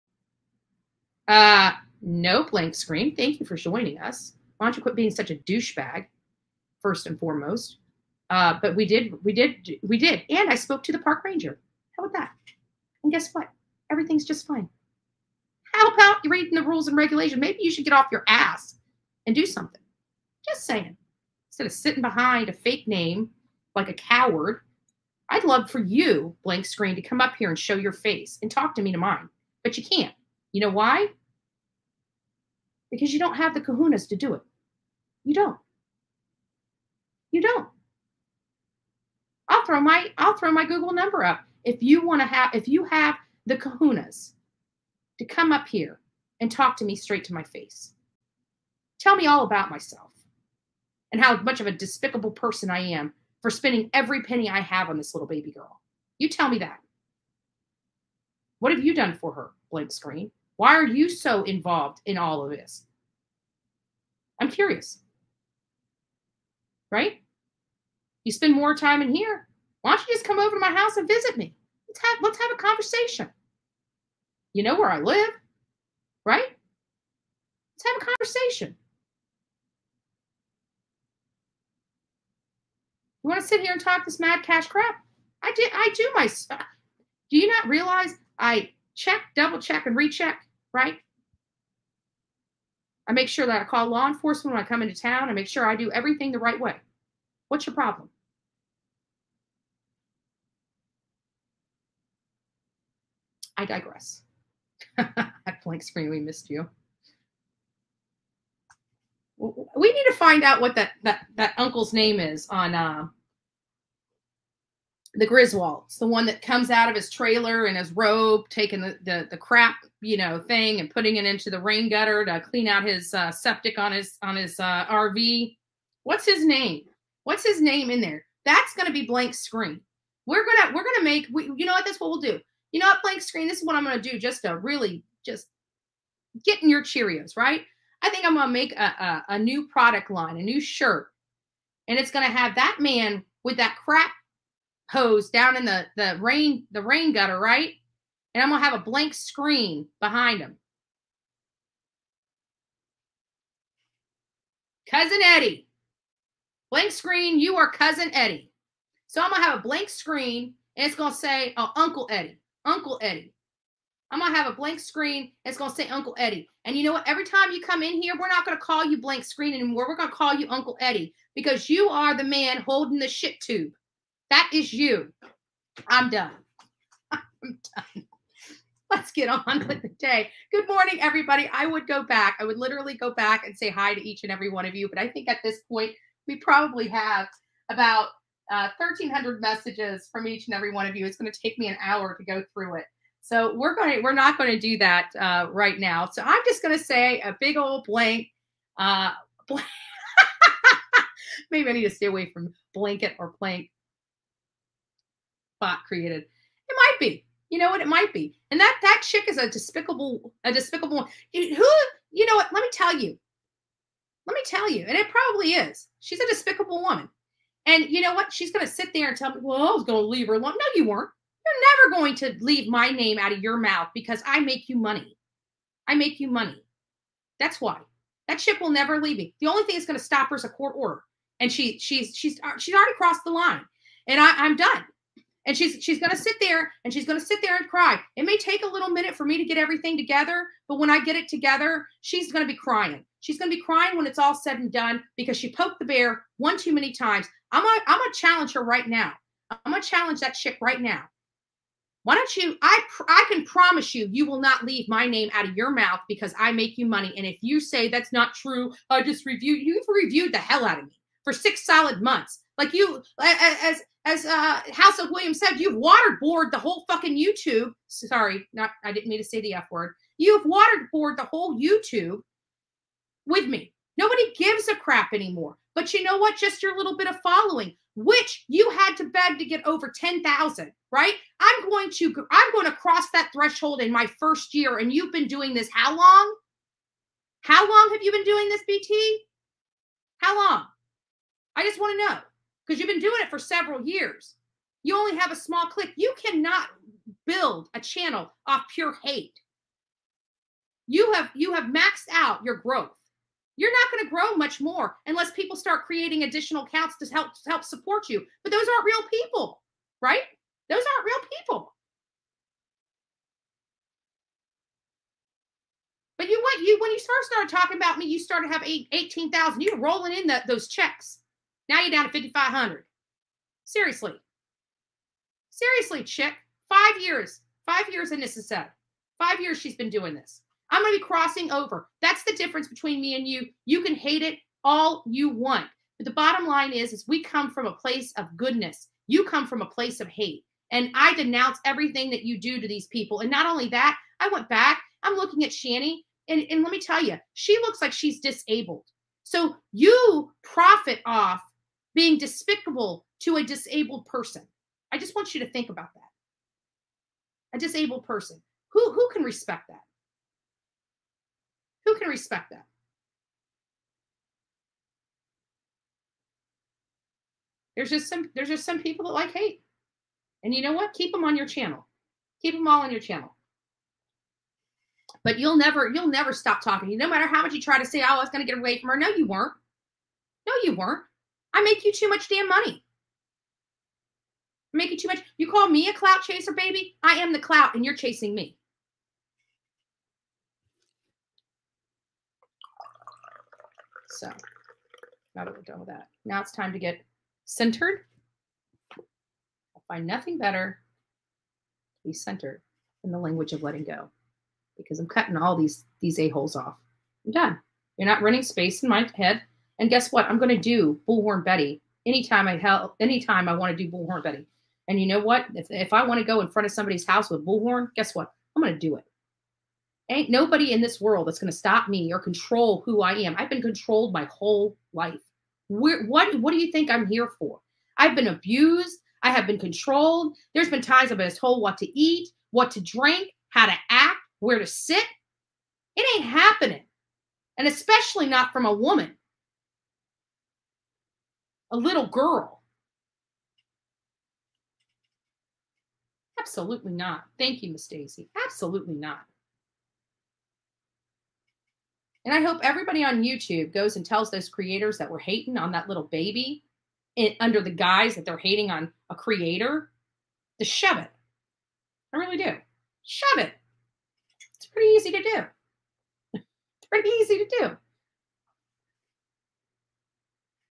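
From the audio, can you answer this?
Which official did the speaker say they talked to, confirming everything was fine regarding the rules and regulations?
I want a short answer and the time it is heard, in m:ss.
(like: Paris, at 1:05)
park ranger, at 0:10.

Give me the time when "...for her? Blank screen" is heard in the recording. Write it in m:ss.
0:59.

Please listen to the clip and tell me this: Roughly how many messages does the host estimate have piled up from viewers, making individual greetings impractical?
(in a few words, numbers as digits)
1,300.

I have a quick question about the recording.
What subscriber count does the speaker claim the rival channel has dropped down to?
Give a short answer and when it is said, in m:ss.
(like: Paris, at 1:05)
5,500, at 5:22.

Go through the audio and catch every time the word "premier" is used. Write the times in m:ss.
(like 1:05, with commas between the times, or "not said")
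not said.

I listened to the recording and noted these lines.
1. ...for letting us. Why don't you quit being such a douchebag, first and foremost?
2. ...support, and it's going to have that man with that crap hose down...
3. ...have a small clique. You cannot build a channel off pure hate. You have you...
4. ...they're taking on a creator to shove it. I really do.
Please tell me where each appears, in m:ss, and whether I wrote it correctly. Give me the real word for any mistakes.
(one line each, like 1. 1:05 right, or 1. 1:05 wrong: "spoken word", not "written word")
1. 0:03 wrong: "joining", not "letting"
2. 2:20 wrong: "shirt", not "support"
3. 4:55 right
4. 7:38 wrong: "hating", not "taking".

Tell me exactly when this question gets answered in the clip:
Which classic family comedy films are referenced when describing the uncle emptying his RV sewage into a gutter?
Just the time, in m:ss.
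1:55.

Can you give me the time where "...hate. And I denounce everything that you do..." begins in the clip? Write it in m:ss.
5:40.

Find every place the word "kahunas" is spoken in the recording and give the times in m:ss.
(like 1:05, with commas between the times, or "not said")
0:33, 0:43.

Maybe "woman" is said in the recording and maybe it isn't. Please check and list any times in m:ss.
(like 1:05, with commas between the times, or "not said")
3:36, 7:18.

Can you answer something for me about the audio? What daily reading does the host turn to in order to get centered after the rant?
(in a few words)
The Language of Letting Go.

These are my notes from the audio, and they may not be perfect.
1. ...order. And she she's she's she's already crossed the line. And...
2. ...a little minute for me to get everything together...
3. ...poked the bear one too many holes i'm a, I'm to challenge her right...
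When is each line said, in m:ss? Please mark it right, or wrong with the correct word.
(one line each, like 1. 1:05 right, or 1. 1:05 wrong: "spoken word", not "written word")
1. 3:50 right
2. 3:58 right
3. 4:05 wrong: "times", not "holes".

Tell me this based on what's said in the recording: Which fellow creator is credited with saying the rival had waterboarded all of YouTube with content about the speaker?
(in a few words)
House of Williams.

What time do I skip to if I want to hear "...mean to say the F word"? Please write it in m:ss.
4:29.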